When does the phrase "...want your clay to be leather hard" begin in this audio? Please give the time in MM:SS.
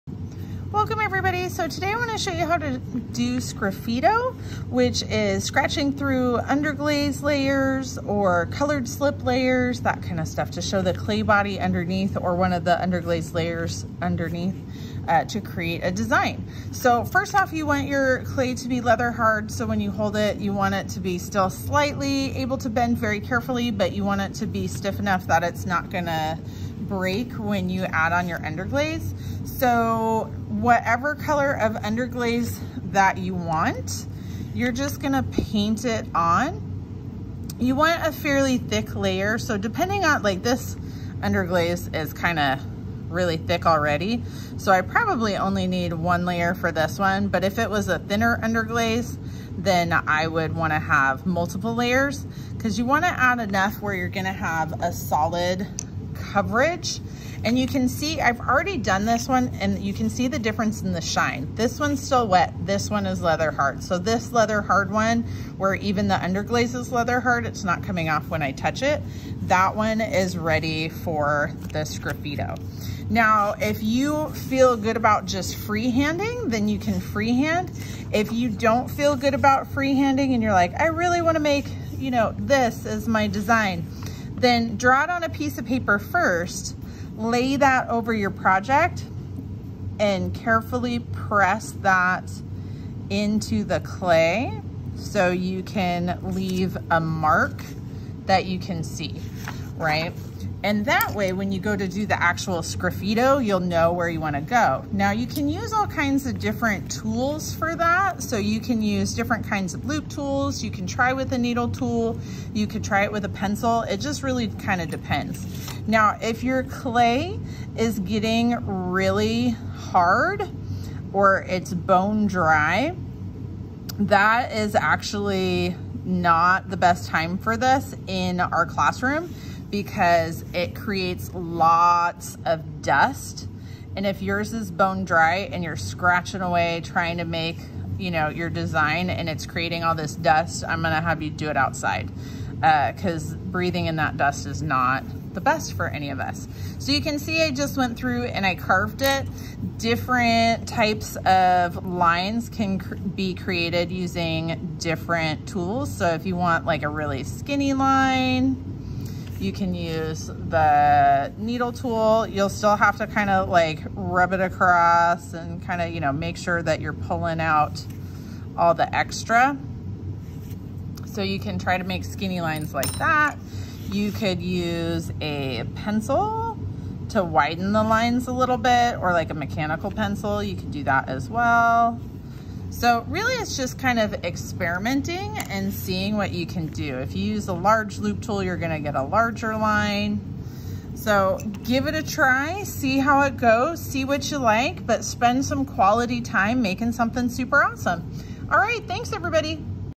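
00:17.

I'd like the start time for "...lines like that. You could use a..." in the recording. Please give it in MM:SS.
02:52.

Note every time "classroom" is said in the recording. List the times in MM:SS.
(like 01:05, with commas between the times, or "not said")
02:08.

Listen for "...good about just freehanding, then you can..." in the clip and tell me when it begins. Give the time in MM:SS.
01:14.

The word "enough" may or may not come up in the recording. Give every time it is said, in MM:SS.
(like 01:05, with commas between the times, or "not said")
00:24, 00:53.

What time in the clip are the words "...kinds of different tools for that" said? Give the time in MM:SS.
01:45.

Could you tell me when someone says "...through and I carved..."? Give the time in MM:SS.
02:27.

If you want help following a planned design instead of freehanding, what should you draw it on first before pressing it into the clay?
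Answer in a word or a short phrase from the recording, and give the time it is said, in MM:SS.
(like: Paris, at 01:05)
A piece of paper, at 01:25.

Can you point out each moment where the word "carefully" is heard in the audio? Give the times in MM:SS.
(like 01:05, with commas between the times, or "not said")
00:23, 01:30.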